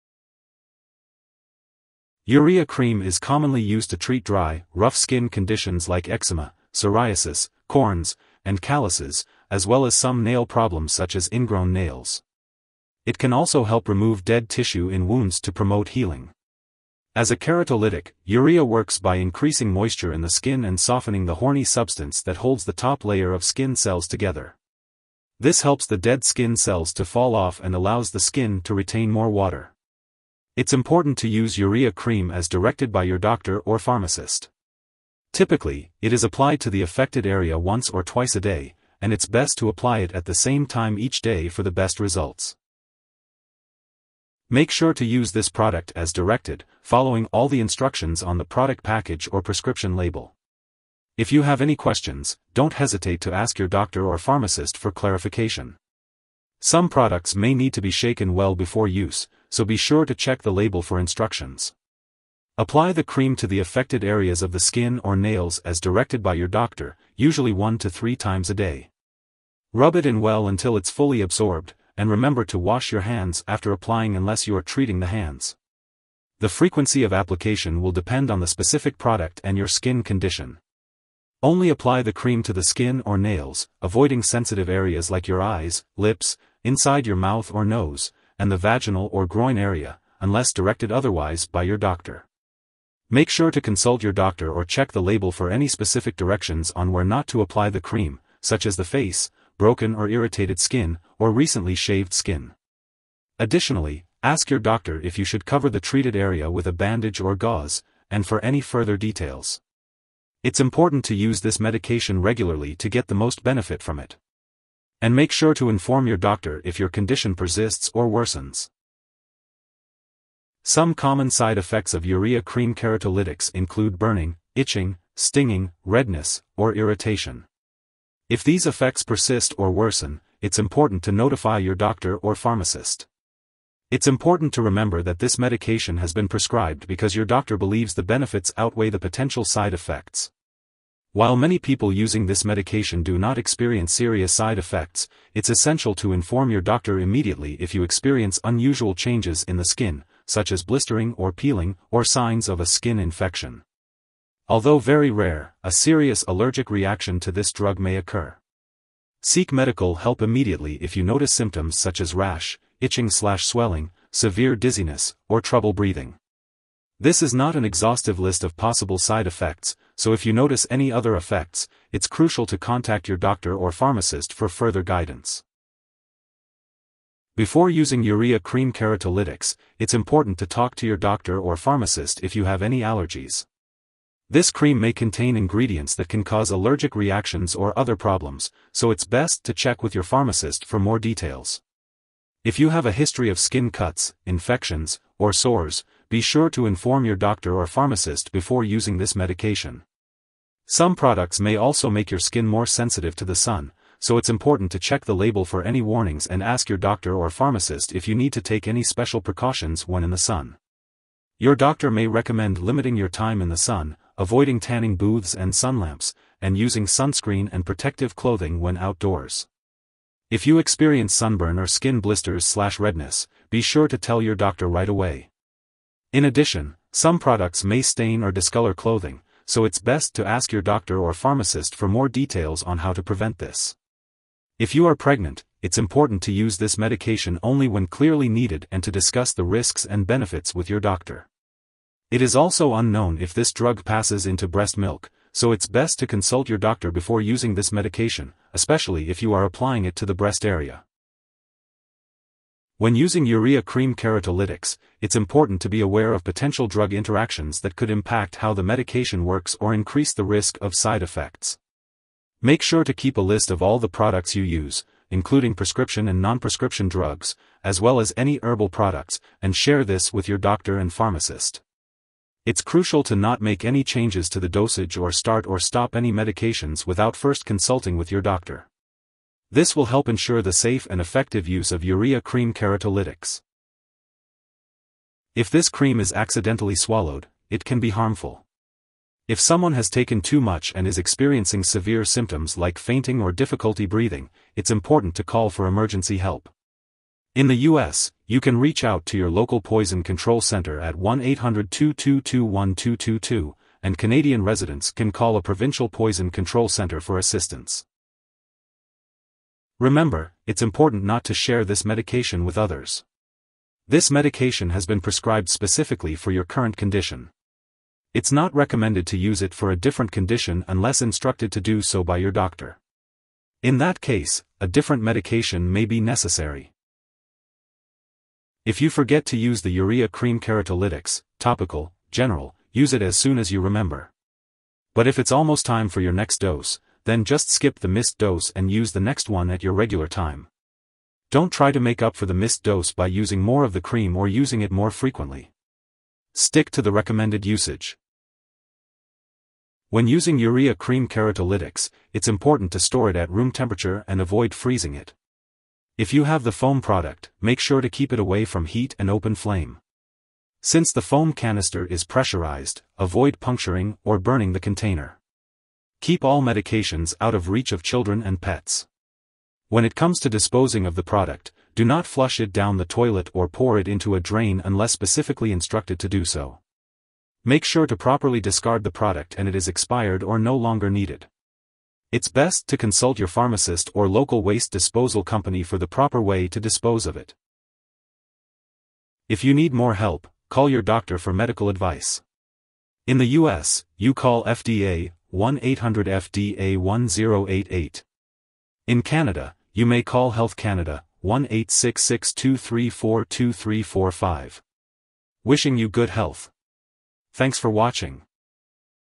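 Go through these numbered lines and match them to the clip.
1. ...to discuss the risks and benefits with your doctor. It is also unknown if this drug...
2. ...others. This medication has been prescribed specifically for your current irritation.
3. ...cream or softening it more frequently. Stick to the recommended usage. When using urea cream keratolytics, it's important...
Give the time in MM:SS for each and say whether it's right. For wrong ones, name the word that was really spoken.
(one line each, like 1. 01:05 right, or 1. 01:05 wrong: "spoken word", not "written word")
1. 03:58 right
2. 05:12 wrong: "condition", not "irritation"
3. 05:43 wrong: "using", not "softening".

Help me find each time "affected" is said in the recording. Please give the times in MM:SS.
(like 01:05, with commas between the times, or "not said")
00:36, 01:03.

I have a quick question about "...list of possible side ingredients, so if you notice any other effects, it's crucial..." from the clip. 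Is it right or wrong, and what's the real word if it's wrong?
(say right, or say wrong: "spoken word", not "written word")
wrong: "effects", not "ingredients".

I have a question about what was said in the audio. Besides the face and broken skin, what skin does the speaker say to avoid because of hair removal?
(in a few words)
Recently shaved skin.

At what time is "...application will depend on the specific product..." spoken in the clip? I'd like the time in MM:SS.
01:17.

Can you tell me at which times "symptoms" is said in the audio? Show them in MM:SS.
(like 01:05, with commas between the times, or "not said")
02:41, 04:52.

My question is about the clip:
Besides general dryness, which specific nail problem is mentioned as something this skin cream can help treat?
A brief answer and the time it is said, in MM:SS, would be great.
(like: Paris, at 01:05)
Ingrown nails, at 00:11.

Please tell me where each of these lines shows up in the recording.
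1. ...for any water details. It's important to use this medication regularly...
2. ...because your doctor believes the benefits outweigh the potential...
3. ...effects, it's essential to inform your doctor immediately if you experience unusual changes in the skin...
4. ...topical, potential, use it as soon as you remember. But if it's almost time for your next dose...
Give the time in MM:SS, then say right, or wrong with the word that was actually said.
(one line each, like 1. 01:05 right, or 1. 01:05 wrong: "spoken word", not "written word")
1. 01:48 wrong: "further", not "water"
2. 02:16 right
3. 02:24 right
4. 05:31 wrong: "general", not "potential".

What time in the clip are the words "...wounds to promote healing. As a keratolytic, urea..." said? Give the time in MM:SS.
00:15.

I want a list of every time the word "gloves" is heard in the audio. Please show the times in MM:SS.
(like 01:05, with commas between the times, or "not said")
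not said.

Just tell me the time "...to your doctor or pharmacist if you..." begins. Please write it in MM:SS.
03:00.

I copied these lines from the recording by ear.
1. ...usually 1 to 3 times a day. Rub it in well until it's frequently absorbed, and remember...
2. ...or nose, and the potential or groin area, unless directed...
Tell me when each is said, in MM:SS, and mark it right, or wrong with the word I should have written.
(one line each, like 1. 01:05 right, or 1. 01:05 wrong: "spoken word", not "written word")
1. 01:07 wrong: "fully", not "frequently"
2. 01:27 wrong: "vaginal", not "potential".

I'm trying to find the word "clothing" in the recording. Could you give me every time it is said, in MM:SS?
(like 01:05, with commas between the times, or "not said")
03:38, 03:48.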